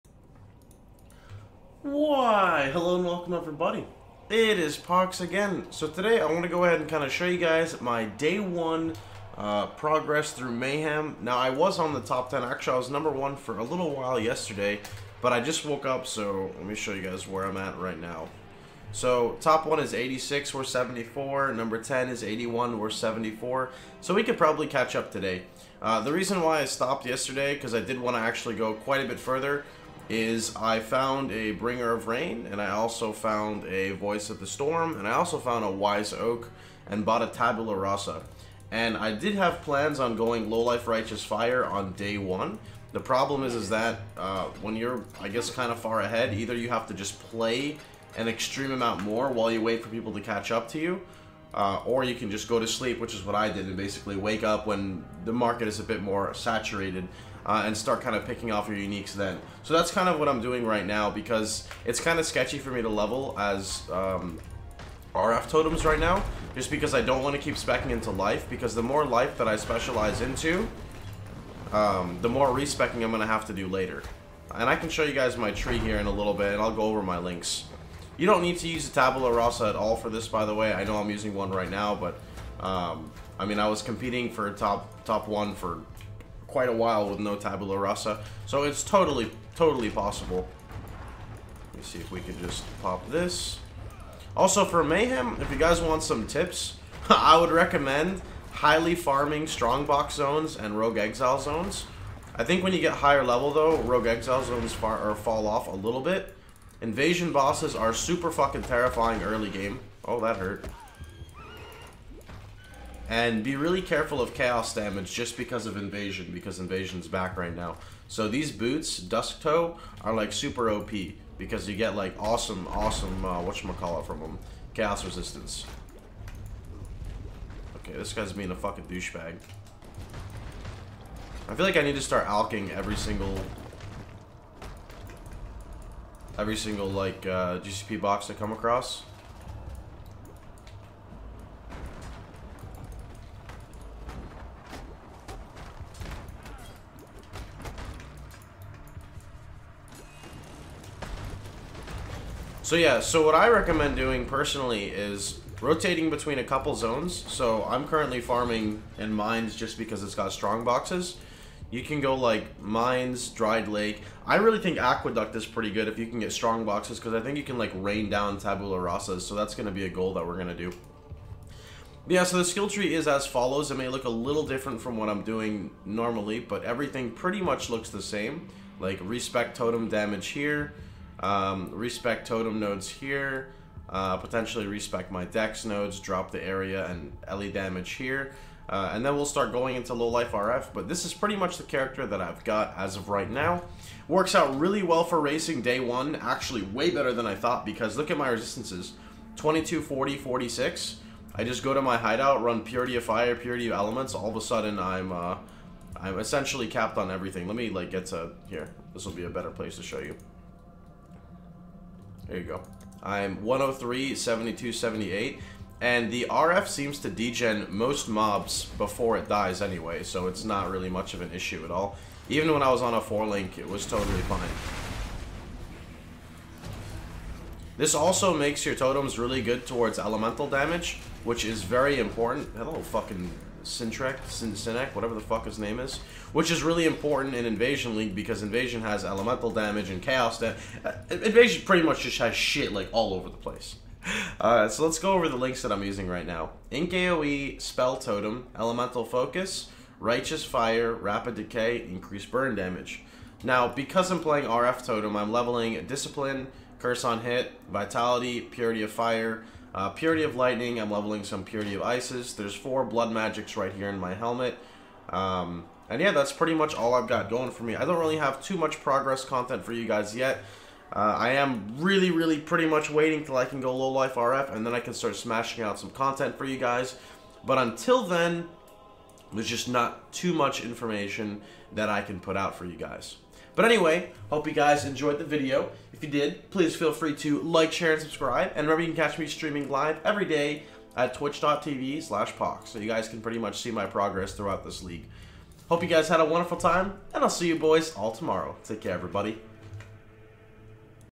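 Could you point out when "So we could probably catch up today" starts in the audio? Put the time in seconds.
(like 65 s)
24 s.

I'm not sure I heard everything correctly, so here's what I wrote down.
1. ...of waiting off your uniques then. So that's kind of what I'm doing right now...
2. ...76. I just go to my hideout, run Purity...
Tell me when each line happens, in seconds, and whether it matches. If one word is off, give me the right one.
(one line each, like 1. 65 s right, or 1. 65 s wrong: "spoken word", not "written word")
1. 58 s wrong: "picking", not "waiting"
2. 200 s wrong: "46", not "76".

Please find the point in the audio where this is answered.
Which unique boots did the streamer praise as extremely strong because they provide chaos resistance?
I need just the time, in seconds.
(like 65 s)
118 s.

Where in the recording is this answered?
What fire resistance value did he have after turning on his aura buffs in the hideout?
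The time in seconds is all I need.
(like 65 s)
213 s.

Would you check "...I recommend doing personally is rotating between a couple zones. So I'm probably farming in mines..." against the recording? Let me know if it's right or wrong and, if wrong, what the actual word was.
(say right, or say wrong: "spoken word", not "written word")
wrong: "currently", not "probably".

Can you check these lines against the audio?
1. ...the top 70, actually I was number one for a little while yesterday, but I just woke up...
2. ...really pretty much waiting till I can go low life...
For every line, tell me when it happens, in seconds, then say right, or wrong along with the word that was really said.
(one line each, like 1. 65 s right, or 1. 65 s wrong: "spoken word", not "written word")
1. 11 s wrong: "10", not "70"
2. 272 s right.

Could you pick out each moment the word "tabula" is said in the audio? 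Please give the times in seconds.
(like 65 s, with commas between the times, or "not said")
37 s, 78 s, 87 s, 168 s.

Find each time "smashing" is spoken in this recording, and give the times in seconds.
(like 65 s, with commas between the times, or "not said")
275 s.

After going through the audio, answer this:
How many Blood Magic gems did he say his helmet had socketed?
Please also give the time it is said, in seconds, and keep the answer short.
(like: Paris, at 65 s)
4, at 262 s.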